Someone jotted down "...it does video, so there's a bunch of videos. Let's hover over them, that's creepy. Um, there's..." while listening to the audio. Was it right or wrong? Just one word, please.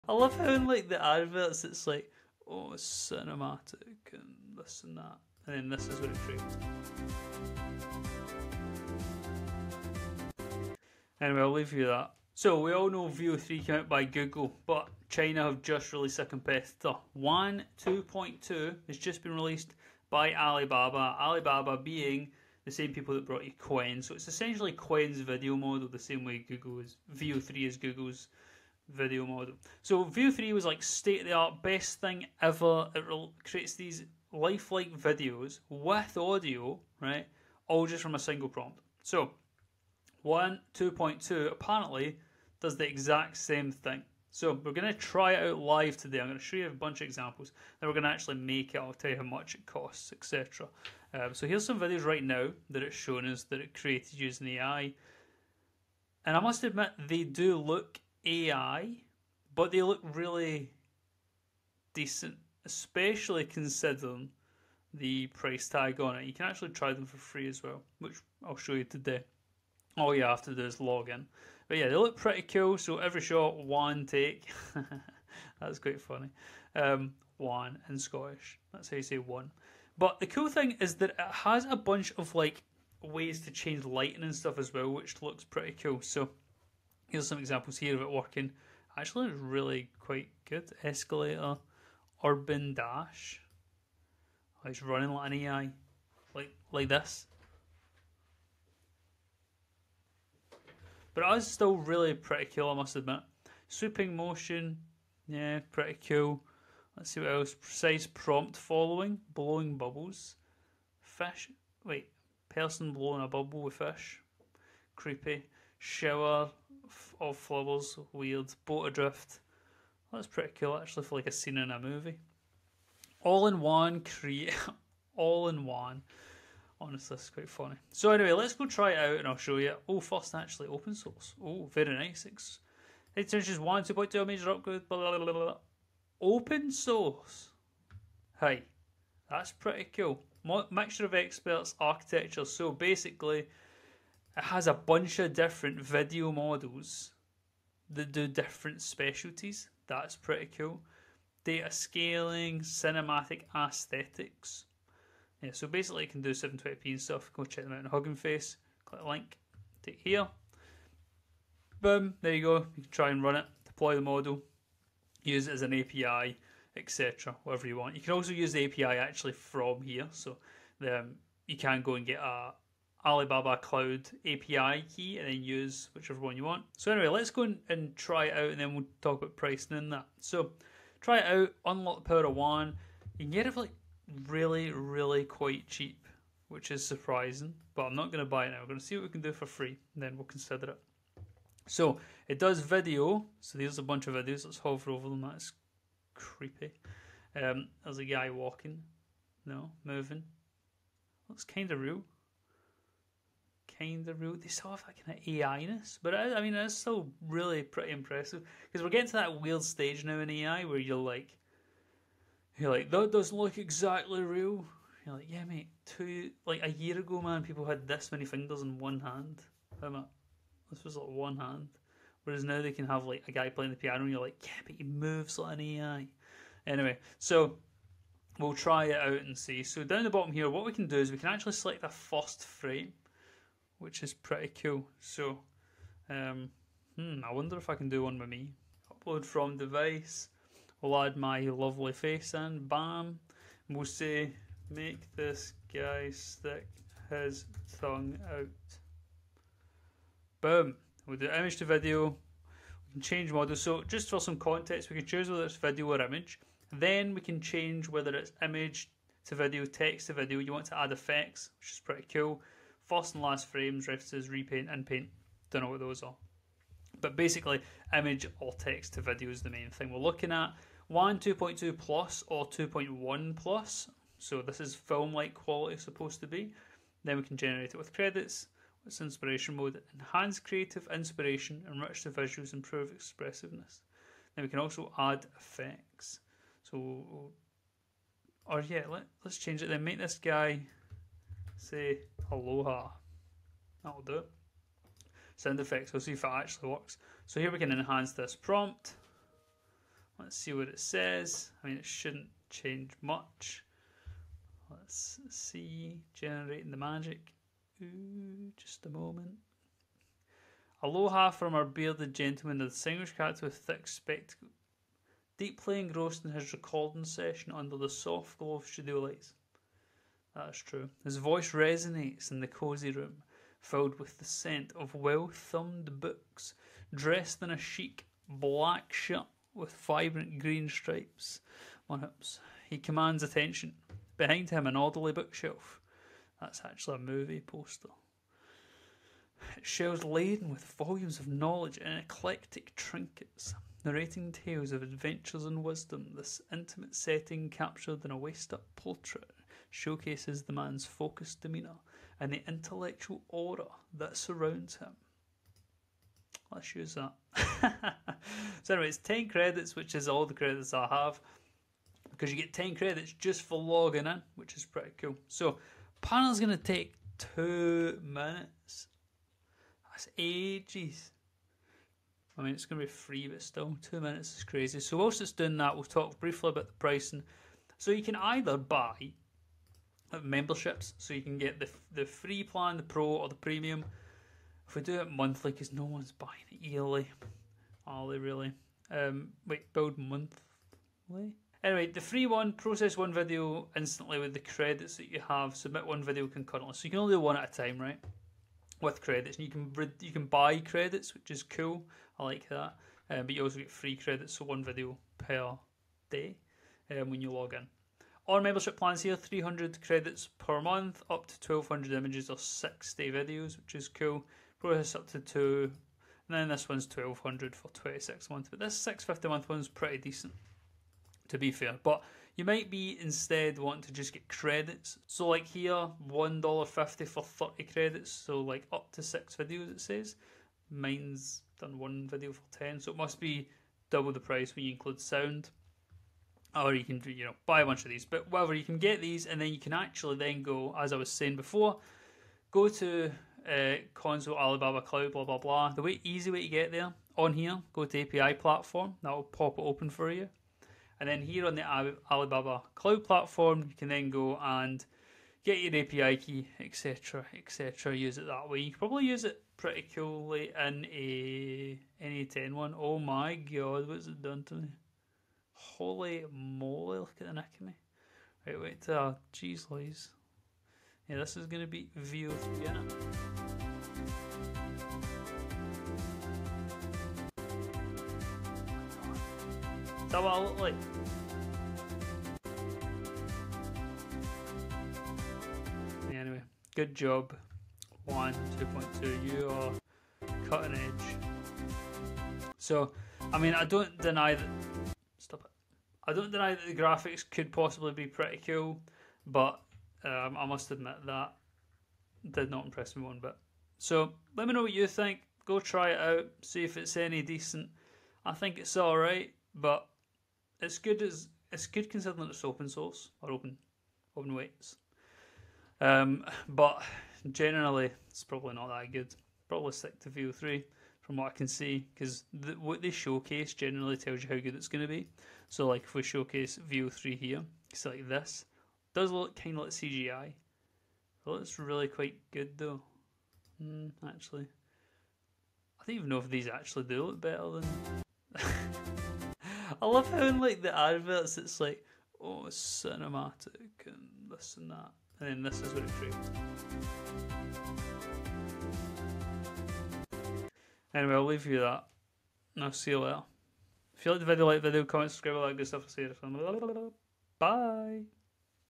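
right.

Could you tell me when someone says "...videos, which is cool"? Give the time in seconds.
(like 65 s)
413 s.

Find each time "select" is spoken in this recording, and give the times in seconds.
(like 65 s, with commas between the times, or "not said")
231 s.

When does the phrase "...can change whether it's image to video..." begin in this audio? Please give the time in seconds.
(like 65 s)
257 s.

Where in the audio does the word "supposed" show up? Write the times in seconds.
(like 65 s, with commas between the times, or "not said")
275 s.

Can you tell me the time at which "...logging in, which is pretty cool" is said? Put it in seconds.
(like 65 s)
363 s.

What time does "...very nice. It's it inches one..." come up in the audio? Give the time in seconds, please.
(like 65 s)
131 s.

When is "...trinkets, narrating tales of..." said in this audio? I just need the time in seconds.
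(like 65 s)
342 s.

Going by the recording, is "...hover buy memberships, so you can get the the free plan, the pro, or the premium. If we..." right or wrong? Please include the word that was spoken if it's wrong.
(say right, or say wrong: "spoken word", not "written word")
wrong: "either", not "hover".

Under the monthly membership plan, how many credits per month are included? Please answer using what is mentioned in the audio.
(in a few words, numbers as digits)
300.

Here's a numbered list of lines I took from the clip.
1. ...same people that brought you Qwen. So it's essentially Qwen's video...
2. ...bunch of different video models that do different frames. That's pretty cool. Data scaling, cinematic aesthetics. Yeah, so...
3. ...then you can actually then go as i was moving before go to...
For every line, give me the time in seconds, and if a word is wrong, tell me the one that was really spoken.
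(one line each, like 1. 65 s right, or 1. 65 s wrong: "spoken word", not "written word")
1. 22 s right
2. 144 s wrong: "specialties", not "frames"
3. 439 s wrong: "saying", not "moving".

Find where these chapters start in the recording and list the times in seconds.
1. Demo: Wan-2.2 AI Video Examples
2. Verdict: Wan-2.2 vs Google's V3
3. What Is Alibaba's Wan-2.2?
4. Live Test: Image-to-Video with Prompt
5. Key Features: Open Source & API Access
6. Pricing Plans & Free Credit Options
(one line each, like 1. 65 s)
1. 45 s
2. 458 s
3. 12 s
4. 180 s
5. 131 s
6. 316 s.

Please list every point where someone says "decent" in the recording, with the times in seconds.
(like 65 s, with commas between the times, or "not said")
61 s, 419 s, 507 s.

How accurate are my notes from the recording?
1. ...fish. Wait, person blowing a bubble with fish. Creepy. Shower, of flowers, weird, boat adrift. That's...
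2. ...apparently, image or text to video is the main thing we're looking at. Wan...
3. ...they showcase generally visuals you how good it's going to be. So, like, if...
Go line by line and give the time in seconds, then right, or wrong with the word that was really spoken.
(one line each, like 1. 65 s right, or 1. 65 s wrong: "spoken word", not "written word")
1. 111 s right
2. 267 s wrong: "basically", not "apparently"
3. 522 s wrong: "tells", not "visuals".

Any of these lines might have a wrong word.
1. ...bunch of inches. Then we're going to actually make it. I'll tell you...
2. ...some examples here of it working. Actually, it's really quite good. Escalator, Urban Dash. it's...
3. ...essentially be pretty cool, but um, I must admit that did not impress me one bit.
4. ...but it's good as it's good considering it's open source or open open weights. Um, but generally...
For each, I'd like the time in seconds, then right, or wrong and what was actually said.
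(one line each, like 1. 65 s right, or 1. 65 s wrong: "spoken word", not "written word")
1. 46 s wrong: "examples", not "inches"
2. 87 s right
3. 497 s wrong: "possibly", not "essentially"
4. 509 s right.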